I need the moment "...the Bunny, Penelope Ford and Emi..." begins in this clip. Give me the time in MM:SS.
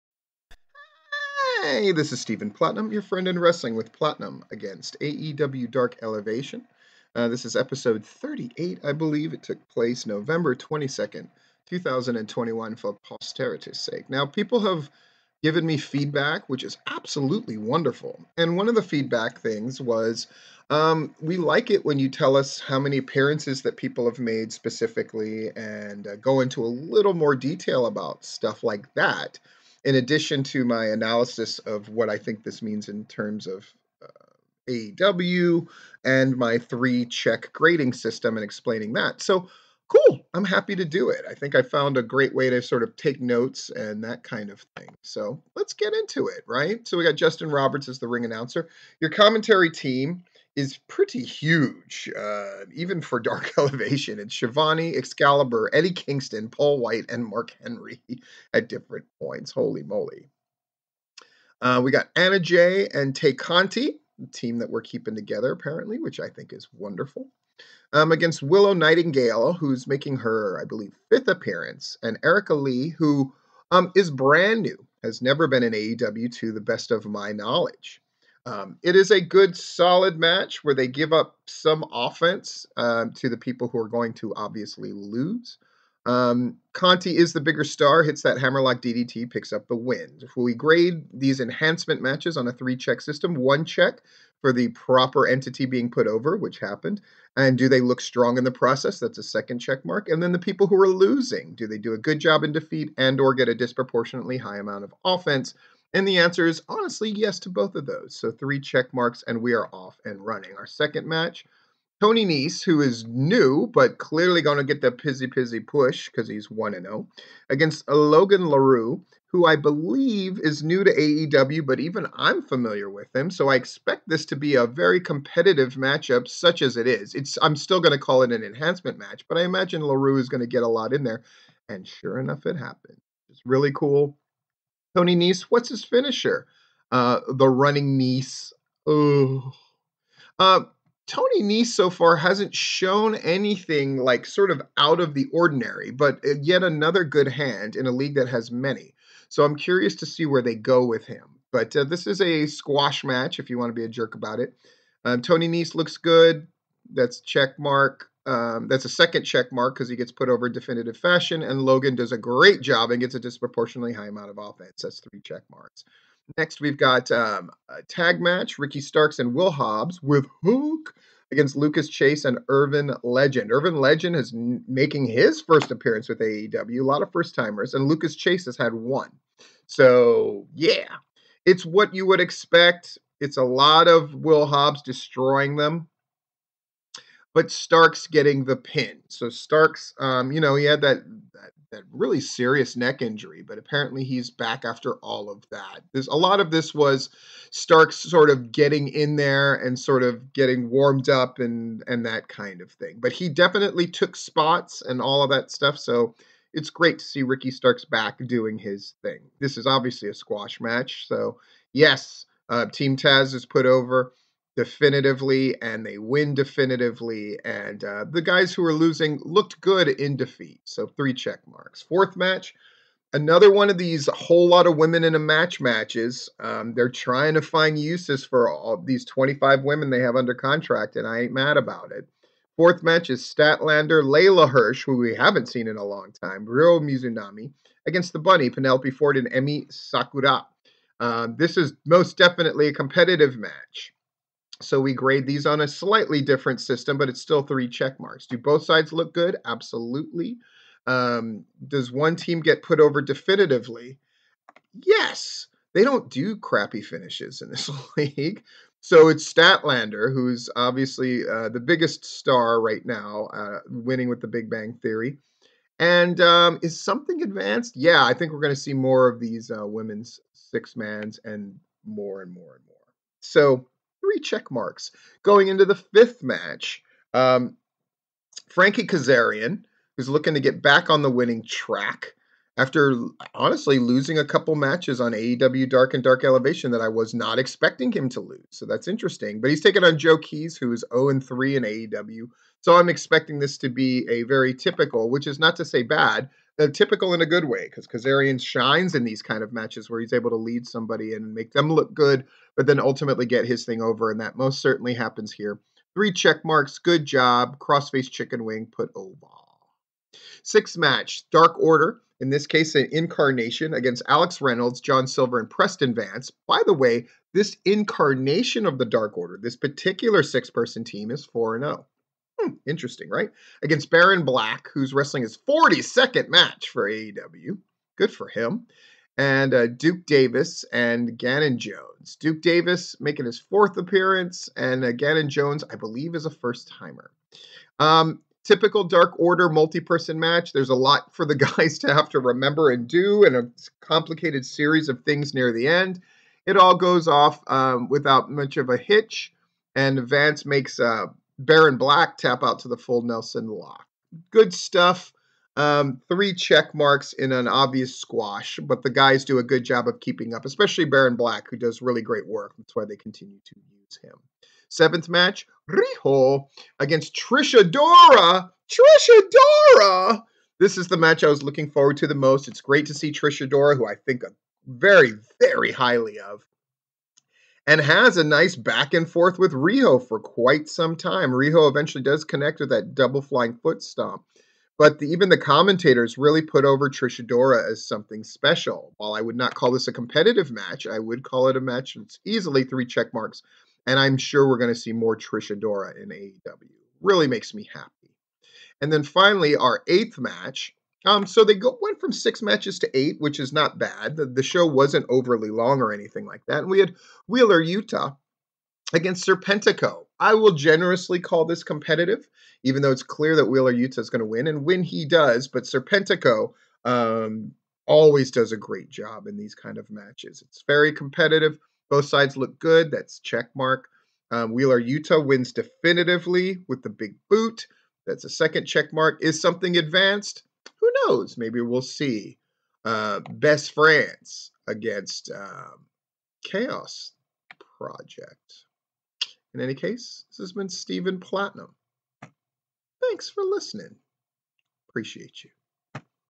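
03:58.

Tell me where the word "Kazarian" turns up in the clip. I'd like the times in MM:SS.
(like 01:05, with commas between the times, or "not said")
04:38, 04:57.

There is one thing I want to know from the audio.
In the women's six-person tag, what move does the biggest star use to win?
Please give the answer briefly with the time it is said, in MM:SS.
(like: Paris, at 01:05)
Big Bang Theory, at 04:24.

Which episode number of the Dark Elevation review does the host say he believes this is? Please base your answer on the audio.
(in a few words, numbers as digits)
38.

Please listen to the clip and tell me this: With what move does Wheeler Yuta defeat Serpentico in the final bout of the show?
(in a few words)
Big boot.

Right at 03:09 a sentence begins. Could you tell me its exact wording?
So Starks, um, you know, he had that, that, that really serious neck injury, but apparently he's back after all of that.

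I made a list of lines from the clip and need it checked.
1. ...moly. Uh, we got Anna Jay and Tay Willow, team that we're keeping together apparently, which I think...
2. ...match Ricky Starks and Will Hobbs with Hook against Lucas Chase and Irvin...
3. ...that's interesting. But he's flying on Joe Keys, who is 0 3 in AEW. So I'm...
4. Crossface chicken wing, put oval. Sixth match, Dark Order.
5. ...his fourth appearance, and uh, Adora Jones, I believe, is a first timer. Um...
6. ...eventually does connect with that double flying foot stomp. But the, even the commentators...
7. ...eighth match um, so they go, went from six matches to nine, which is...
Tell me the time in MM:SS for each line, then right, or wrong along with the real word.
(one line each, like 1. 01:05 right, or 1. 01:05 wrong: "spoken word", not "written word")
1. 00:59 wrong: "Conti", not "Willow"
2. 02:48 right
3. 04:48 wrong: "taking", not "flying"
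4. 05:07 right
5. 05:33 wrong: "Gannon", not "Adora"
6. 06:21 right
7. 06:39 wrong: "eight", not "nine".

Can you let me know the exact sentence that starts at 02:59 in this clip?
So, yeah, it's what you would expect.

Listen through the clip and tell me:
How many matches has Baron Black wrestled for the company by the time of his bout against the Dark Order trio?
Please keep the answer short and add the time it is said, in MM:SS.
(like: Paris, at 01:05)
42, at 05:25.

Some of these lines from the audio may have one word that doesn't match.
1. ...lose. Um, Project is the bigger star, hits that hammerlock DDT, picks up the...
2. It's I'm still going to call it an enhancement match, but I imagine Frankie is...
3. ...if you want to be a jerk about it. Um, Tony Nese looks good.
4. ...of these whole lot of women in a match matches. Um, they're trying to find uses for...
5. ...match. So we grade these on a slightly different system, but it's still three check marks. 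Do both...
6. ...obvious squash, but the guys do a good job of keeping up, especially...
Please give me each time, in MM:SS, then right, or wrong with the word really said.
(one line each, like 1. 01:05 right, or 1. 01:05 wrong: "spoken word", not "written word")
1. 01:24 wrong: "Conti", not "Project"
2. 02:07 wrong: "LaRue", not "Frankie"
3. 02:33 right
4. 03:43 right
5. 04:03 right
6. 05:57 right.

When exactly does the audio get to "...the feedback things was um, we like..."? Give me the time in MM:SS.
00:18.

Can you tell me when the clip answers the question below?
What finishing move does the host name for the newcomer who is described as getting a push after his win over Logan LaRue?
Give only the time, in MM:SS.
02:17.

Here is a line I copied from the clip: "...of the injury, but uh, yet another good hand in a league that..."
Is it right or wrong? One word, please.
wrong.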